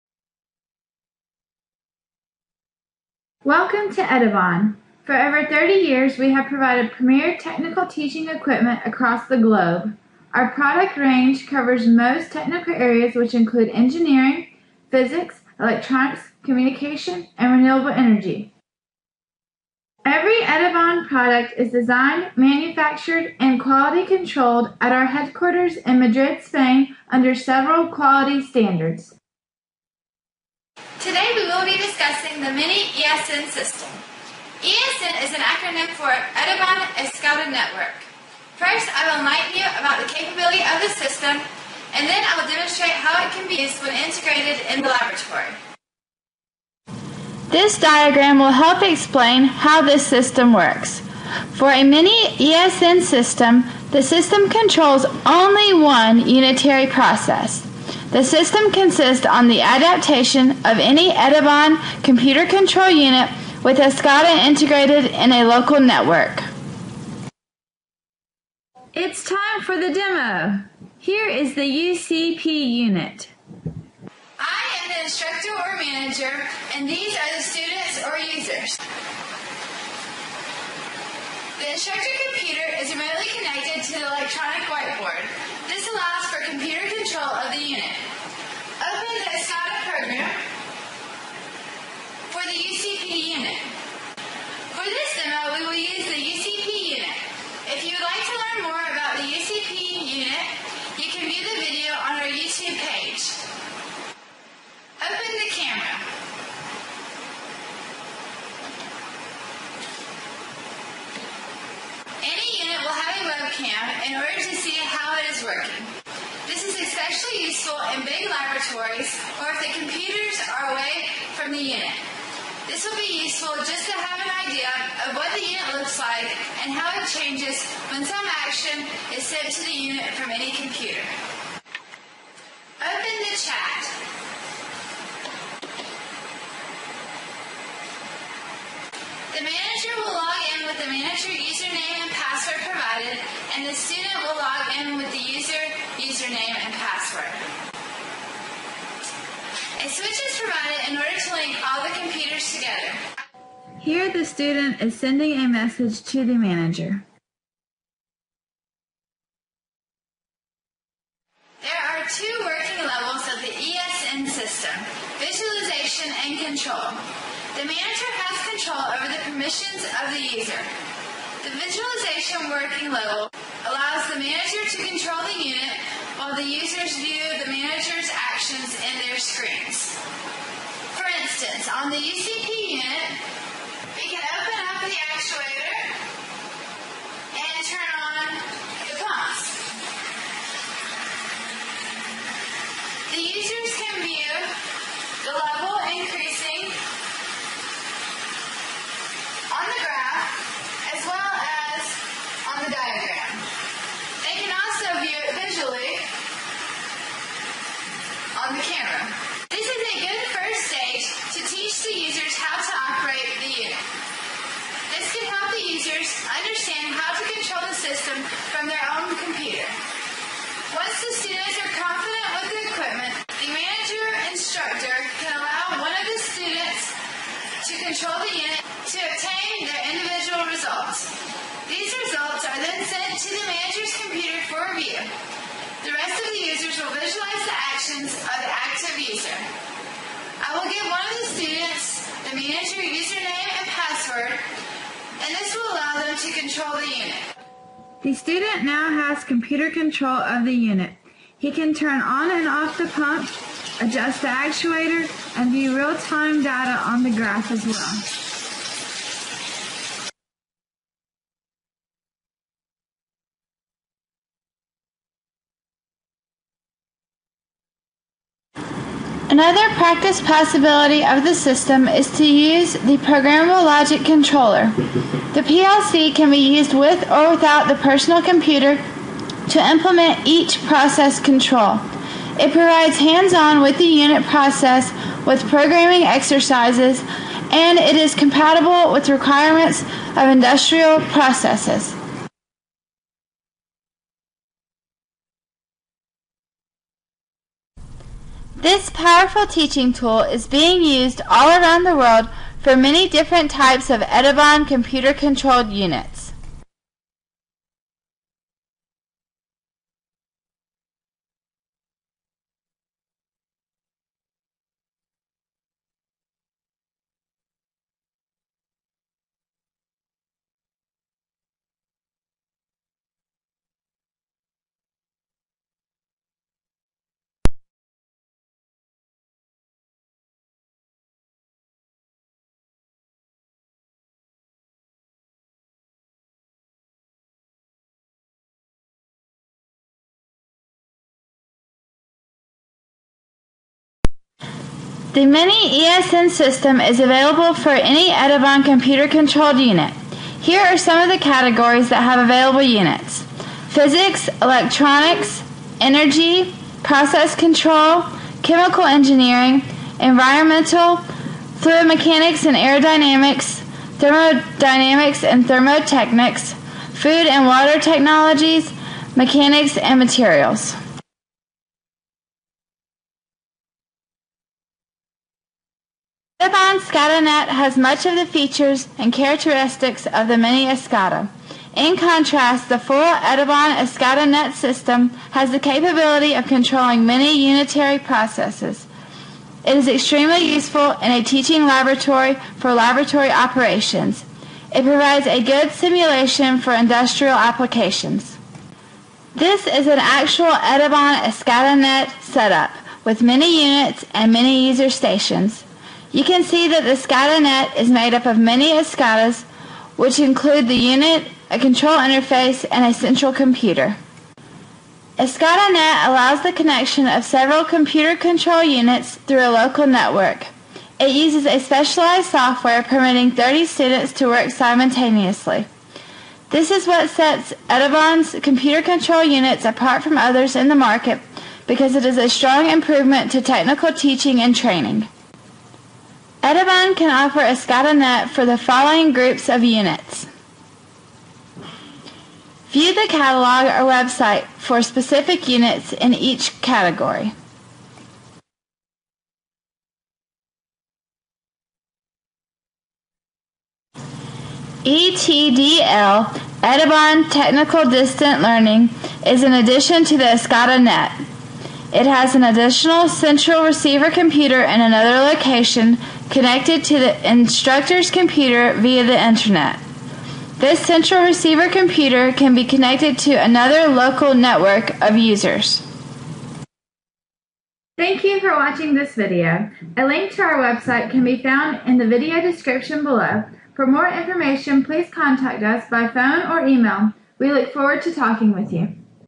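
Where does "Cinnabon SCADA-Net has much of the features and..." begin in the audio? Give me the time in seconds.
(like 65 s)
376 s.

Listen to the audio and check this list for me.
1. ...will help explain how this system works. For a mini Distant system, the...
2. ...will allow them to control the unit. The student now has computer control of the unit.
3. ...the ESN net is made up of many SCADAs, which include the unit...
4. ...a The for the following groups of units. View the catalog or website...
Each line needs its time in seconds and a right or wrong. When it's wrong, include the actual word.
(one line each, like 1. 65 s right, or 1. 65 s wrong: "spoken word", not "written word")
1. 48 s wrong: "ESN", not "Distant"
2. 245 s right
3. 406 s wrong: "SCADA", not "ESN"
4. 437 s wrong: "SCADAnet", not "The".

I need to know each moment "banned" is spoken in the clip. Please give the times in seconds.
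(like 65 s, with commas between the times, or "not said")
not said.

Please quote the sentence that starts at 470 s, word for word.
This central receiver computer can be connected to another local network of users.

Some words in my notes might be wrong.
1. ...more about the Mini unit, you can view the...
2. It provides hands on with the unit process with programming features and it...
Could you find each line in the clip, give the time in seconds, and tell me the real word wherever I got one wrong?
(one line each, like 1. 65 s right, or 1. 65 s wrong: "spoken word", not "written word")
1. 98 s wrong: "UCP", not "Mini"
2. 282 s wrong: "exercises", not "features".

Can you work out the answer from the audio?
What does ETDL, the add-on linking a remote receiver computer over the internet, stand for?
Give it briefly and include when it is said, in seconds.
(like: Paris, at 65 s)
Edibon Technical Distant Learning, at 456 s.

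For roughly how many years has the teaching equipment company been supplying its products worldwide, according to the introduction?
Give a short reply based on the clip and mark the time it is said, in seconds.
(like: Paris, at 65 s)
Over 30 years, at 5 s.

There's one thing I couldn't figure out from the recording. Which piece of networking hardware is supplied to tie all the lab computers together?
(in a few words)
A switch.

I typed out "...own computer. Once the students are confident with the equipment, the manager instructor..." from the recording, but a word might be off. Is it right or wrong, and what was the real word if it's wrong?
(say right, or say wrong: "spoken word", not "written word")
right.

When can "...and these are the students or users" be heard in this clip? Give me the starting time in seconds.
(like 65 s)
76 s.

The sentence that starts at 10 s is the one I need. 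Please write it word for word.
Our product range covers most technical areas, which include engineering, physics, electronics, communication, and renewable energy.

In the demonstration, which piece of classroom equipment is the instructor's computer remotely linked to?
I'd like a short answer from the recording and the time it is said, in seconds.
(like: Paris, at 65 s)
Electronic whiteboard, at 84 s.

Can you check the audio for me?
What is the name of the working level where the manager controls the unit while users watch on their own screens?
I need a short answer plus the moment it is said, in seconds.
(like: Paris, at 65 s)
Visualization working level, at 171 s.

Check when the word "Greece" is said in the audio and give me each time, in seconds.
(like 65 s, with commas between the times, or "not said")
not said.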